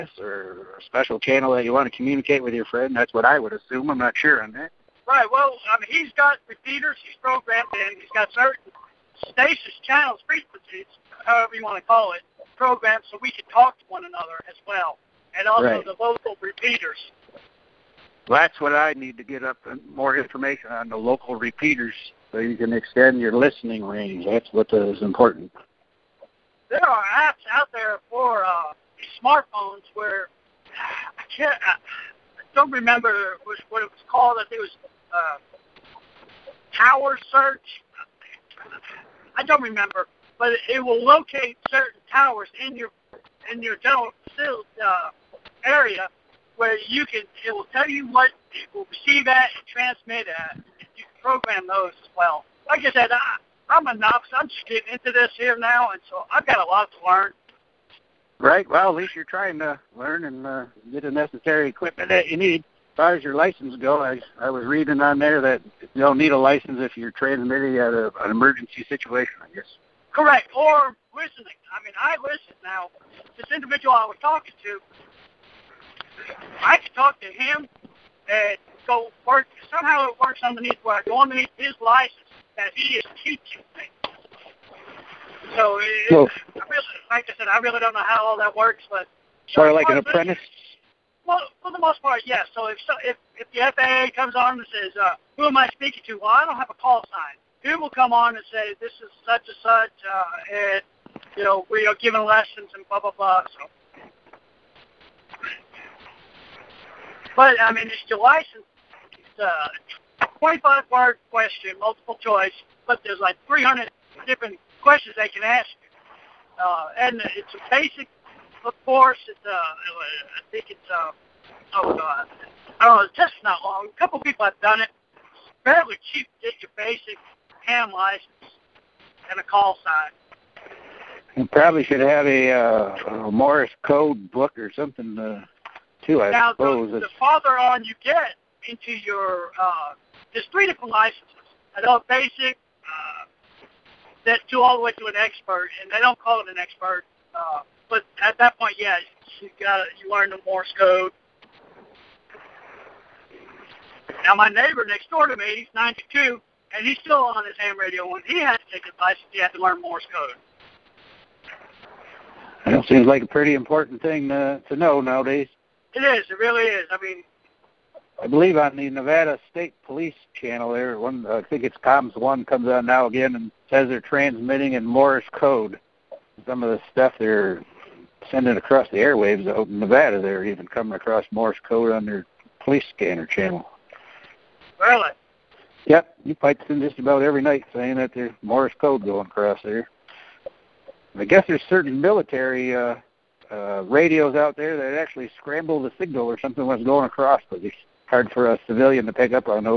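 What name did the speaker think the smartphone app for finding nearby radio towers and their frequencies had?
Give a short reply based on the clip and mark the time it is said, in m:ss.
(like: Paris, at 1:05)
Tower Search, at 0:36.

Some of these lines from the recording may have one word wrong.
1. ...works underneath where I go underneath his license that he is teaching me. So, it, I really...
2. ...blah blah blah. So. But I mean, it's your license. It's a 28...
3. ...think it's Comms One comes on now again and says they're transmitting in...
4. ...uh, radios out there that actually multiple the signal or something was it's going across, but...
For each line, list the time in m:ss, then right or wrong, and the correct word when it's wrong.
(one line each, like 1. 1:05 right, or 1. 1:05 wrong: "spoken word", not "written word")
1. 1:20 right
2. 1:42 wrong: "25", not "28"
3. 2:51 right
4. 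3:13 wrong: "scramble", not "multiple".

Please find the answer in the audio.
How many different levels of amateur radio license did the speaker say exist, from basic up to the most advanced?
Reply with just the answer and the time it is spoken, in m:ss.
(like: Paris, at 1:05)
3, at 2:20.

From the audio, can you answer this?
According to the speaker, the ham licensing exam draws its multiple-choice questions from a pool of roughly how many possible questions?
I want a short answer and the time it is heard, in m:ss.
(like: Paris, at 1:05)
300, at 1:53.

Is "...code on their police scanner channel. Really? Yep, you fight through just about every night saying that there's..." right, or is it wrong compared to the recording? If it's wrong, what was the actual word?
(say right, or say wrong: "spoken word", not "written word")
right.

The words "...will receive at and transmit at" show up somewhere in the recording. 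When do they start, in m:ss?
0:48.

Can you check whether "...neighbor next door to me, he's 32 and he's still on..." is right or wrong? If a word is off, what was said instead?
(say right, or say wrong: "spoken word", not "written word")
wrong: "92", not "32".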